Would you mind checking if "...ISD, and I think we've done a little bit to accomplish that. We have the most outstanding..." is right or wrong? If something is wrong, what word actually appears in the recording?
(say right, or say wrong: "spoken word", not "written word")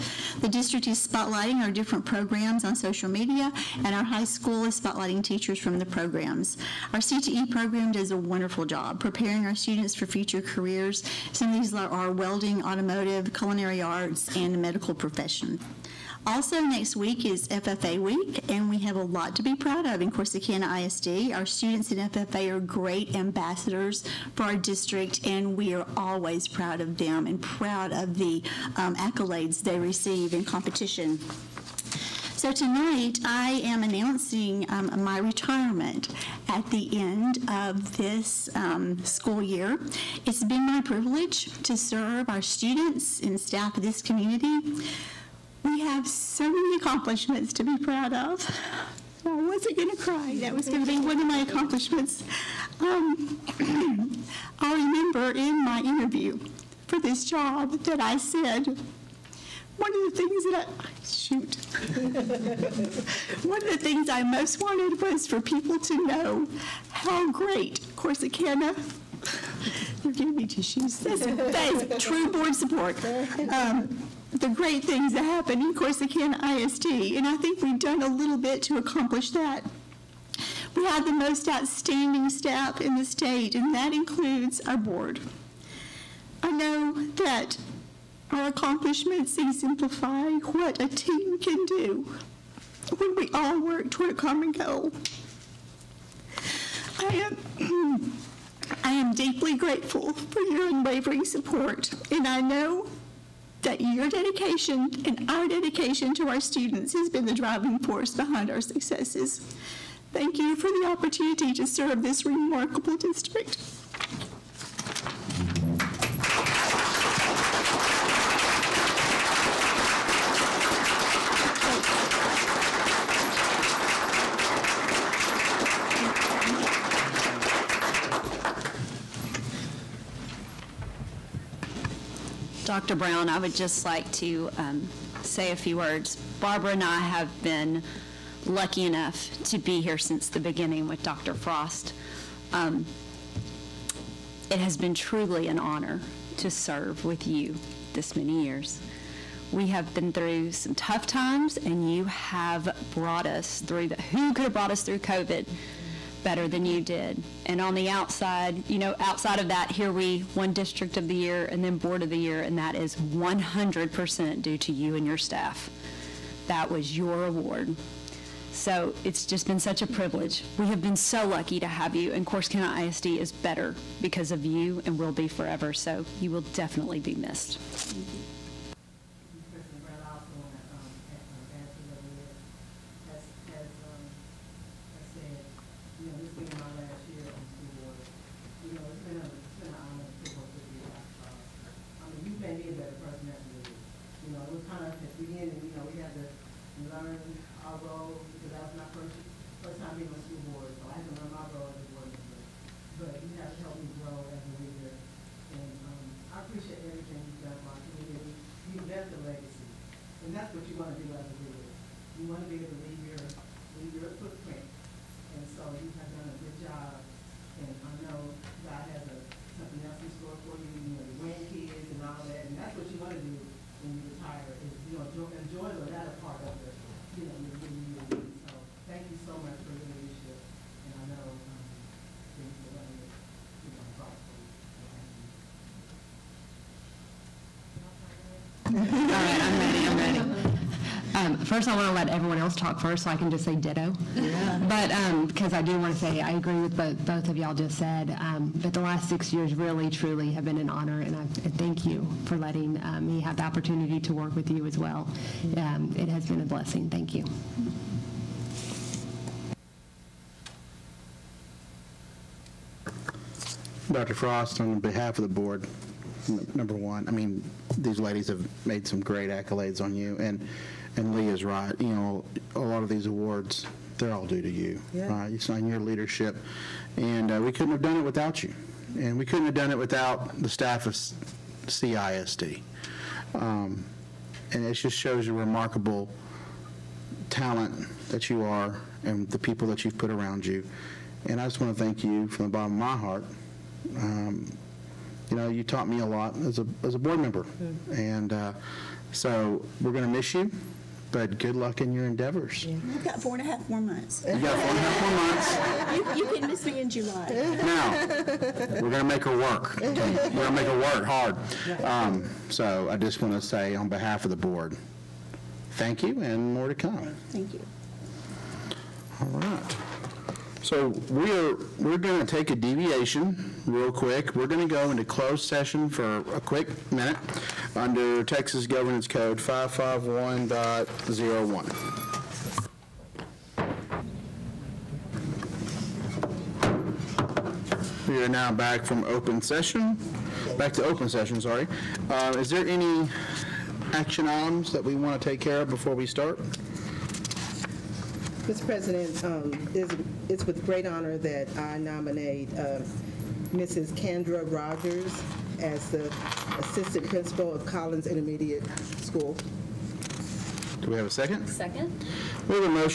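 right.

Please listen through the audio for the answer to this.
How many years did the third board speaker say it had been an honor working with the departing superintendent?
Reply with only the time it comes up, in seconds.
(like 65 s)
249 s.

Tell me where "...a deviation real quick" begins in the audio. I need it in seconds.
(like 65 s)
322 s.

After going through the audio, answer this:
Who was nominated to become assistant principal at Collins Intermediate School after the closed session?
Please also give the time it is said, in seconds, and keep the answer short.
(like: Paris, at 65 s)
Kendra Rogers, at 353 s.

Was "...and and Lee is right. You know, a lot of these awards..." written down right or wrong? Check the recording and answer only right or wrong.
right.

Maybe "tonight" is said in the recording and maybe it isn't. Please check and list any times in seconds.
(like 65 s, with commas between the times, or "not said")
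32 s.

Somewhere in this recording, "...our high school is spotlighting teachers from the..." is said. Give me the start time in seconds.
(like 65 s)
3 s.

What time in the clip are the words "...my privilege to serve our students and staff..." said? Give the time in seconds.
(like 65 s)
40 s.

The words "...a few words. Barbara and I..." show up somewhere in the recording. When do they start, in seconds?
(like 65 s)
135 s.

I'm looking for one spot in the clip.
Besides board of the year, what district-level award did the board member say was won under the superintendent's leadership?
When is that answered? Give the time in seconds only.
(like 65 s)
160 s.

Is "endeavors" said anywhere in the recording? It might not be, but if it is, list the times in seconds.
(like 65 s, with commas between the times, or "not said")
302 s.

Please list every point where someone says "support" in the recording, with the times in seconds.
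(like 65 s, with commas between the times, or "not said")
72 s, 101 s.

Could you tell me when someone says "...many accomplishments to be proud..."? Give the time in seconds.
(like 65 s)
46 s.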